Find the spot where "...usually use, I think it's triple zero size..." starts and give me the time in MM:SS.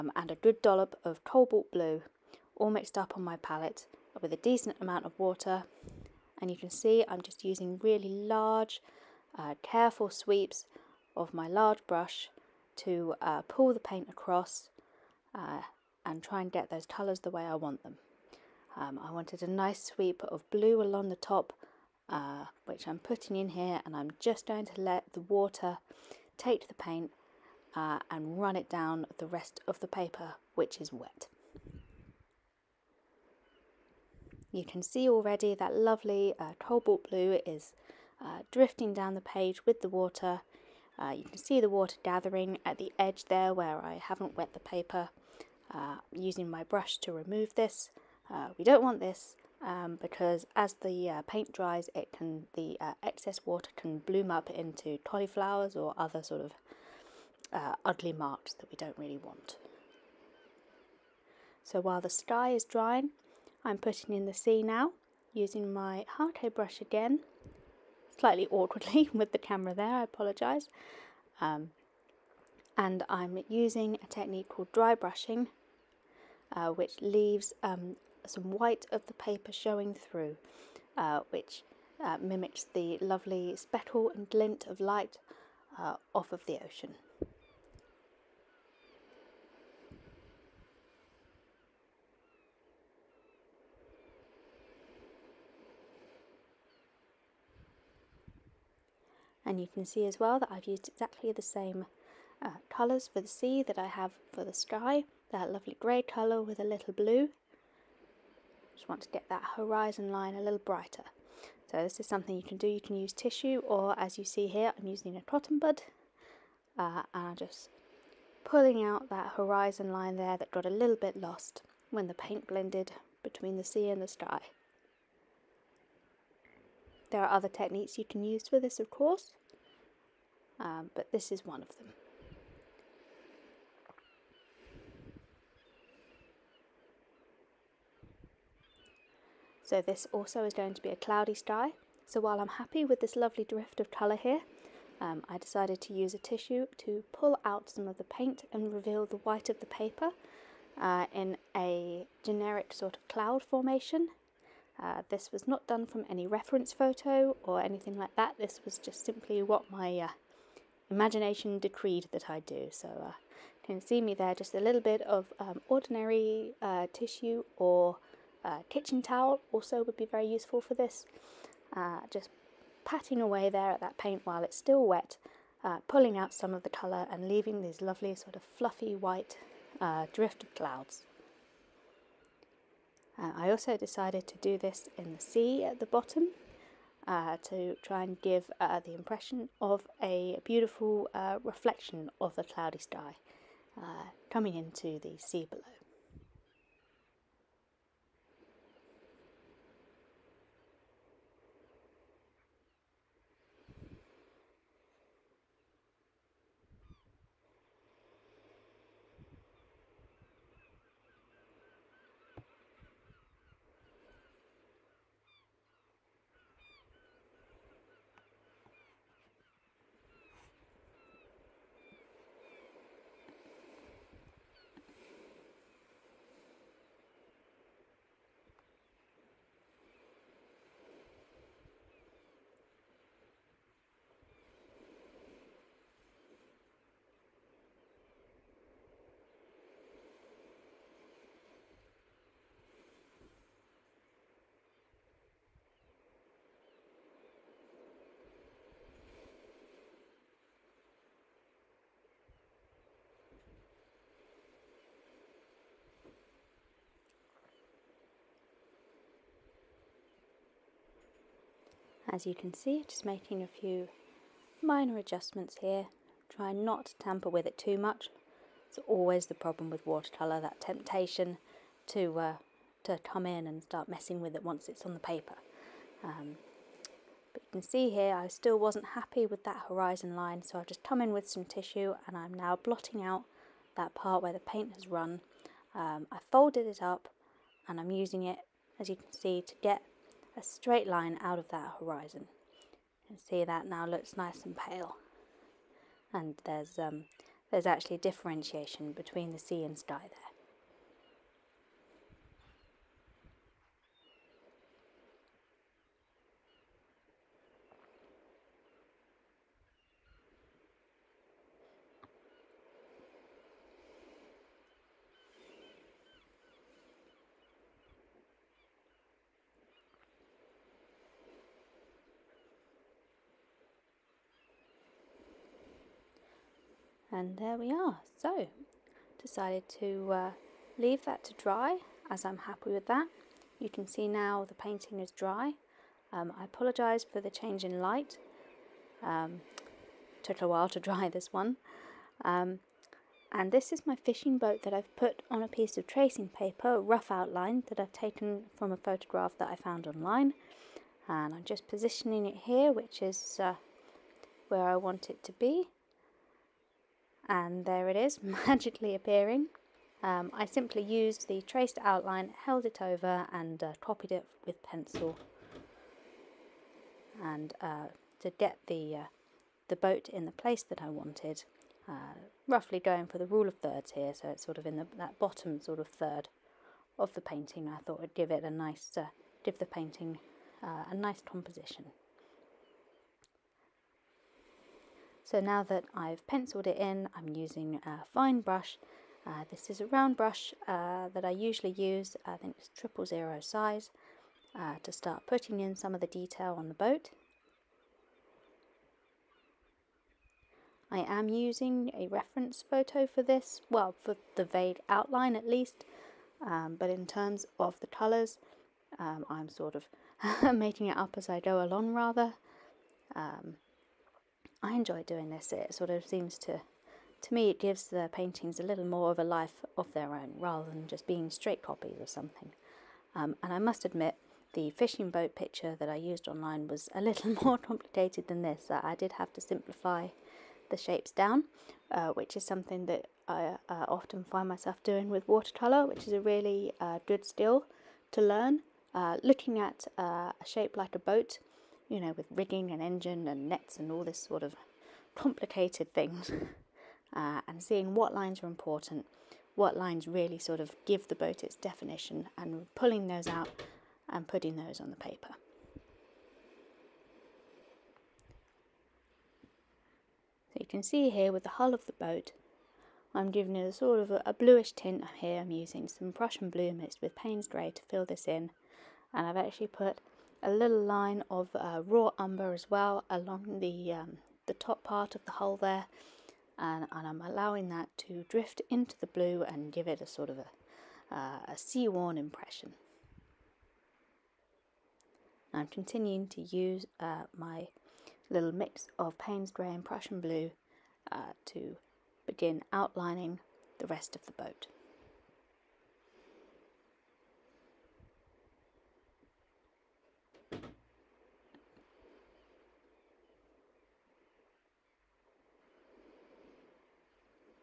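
06:31.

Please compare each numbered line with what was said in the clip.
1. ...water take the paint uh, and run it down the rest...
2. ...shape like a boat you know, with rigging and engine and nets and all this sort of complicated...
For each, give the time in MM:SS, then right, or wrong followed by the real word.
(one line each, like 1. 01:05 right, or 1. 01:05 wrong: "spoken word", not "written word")
1. 00:25 right
2. 07:20 right.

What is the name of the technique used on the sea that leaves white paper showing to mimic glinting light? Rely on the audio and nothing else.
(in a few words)
dry brushing.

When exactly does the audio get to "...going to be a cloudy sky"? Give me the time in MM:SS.
02:20.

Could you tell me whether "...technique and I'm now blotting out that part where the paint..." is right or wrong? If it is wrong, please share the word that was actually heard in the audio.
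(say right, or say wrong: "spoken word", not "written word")
wrong: "tissue", not "technique".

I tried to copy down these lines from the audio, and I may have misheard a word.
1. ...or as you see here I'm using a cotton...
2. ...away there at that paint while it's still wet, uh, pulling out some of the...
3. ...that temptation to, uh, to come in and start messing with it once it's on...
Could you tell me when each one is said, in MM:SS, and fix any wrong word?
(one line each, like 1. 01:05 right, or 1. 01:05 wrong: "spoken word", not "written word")
1. 01:53 right
2. 02:53 right
3. 04:30 right.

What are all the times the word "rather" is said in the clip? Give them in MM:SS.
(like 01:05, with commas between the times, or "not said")
06:51, 07:00.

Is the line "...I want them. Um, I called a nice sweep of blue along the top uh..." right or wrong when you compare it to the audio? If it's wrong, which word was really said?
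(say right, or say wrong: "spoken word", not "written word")
wrong: "wanted", not "called".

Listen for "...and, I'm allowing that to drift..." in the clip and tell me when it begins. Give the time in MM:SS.
07:56.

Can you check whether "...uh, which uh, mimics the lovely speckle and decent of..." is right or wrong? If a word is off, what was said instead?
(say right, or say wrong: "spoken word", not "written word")
wrong: "glint", not "decent".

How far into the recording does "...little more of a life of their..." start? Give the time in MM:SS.
06:58.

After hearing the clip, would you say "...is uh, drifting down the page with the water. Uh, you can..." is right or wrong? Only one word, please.
right.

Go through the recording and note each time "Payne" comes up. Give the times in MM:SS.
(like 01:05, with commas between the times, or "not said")
07:47, 08:09.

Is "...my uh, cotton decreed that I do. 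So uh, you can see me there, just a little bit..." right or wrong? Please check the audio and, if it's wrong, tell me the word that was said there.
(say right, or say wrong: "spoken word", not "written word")
wrong: "imagination", not "cotton".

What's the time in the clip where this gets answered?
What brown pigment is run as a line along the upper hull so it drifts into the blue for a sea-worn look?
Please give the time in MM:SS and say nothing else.
07:51.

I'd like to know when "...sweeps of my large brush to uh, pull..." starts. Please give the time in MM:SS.
00:10.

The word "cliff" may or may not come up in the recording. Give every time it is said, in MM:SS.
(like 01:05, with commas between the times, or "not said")
not said.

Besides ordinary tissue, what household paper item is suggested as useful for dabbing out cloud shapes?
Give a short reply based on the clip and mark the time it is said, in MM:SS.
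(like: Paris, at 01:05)
kitchen towel, at 02:48.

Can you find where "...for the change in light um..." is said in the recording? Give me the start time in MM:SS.
05:37.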